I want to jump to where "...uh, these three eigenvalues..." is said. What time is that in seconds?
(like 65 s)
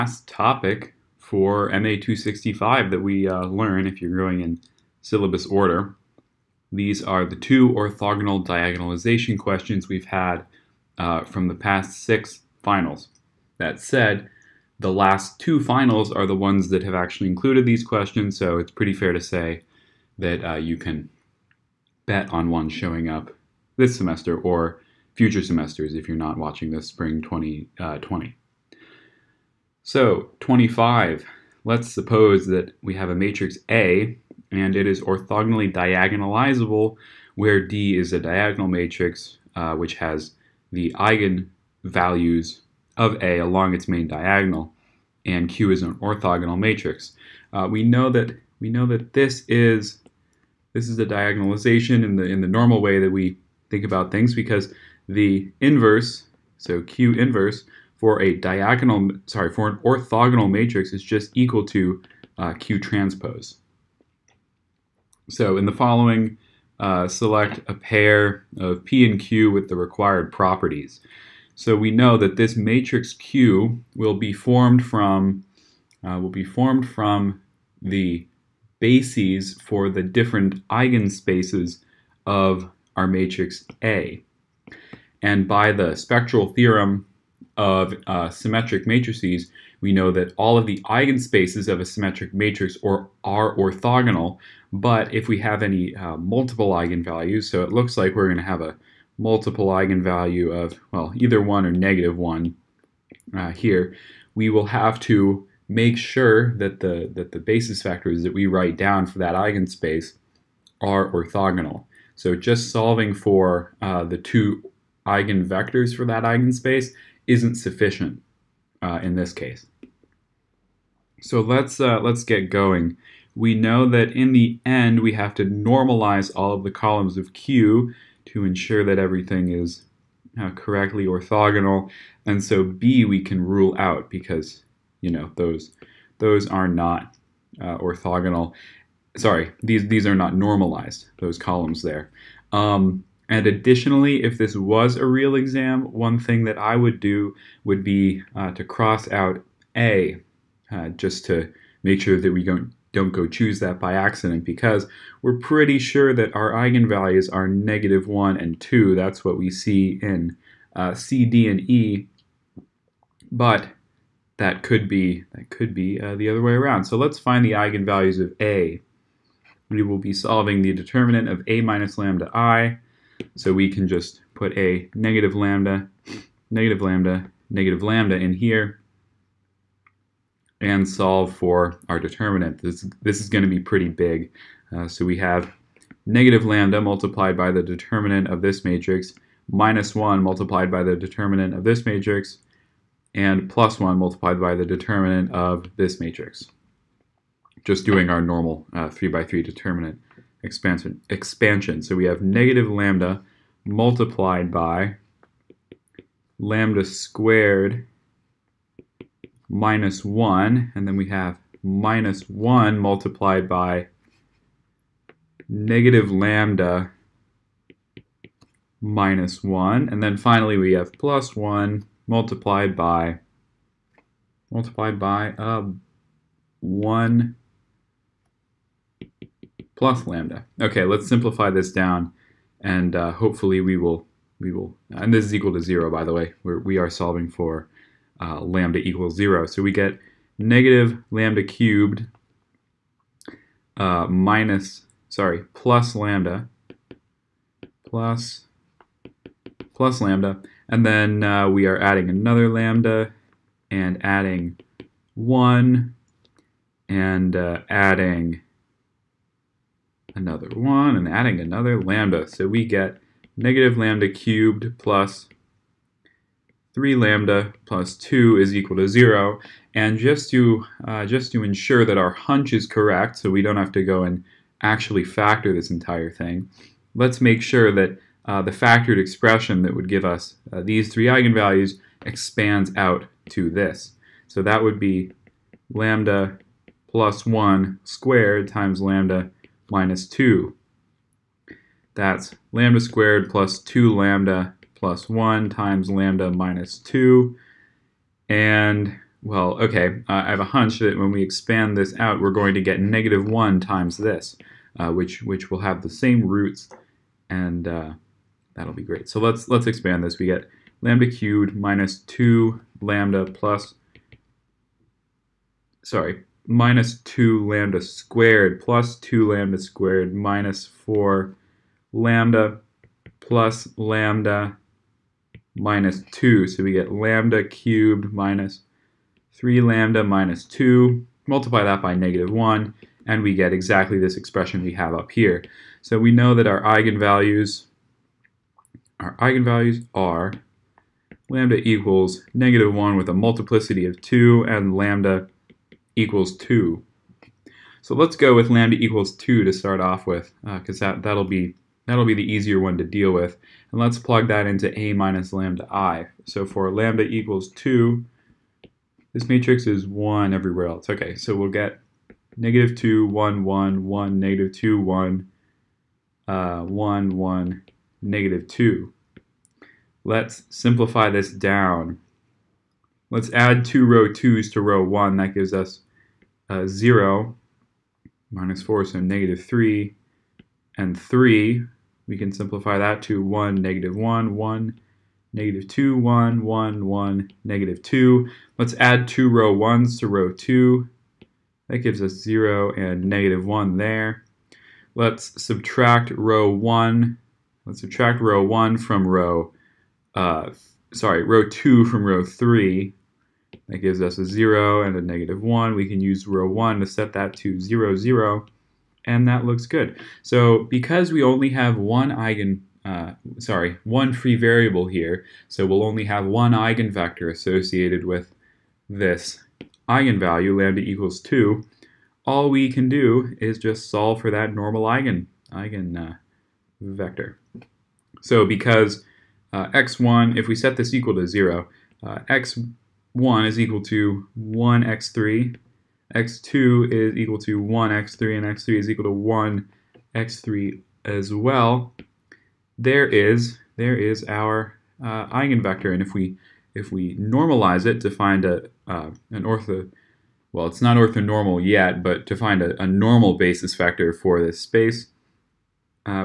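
280 s.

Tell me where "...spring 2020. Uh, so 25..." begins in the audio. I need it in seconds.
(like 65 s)
26 s.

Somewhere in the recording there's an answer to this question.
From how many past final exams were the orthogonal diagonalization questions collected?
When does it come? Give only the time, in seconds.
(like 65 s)
12 s.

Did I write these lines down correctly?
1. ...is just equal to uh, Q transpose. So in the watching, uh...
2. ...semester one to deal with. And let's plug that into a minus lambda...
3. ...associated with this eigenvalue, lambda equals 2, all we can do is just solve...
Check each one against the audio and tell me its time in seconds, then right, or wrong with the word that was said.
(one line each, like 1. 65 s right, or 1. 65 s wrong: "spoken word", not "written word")
1. 60 s wrong: "following", not "watching"
2. 352 s wrong: "easier", not "semester"
3. 417 s right.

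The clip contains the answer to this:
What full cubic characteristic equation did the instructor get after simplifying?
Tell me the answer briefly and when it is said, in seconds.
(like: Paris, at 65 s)
-λ³ + 3λ + 2 = 0, at 263 s.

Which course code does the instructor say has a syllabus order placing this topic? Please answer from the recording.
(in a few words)
MA 265.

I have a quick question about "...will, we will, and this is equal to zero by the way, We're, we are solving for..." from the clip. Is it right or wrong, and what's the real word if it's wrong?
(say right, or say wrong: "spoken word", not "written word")
right.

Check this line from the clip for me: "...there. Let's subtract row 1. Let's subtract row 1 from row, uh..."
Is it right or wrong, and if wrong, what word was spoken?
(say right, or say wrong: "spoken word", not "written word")
right.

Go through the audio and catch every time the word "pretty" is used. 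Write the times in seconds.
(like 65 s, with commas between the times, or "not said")
18 s, 155 s, 183 s.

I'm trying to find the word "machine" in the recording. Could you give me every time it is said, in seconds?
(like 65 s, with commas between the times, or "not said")
not said.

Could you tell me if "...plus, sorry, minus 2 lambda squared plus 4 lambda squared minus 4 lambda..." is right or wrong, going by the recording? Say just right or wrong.
wrong.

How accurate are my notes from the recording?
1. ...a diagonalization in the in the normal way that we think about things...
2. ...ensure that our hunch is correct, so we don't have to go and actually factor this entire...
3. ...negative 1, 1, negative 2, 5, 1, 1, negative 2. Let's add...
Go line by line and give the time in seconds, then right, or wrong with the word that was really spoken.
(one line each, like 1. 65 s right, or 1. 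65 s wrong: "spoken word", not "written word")
1. 50 s right
2. 271 s right
3. 383 s wrong: "1", not "5".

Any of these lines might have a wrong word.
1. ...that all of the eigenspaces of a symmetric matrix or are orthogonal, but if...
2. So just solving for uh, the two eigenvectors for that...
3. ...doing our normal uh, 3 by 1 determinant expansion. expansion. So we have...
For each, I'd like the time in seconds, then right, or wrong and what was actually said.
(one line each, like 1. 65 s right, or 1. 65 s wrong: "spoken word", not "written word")
1. 90 s right
2. 112 s right
3. 197 s wrong: "3", not "1".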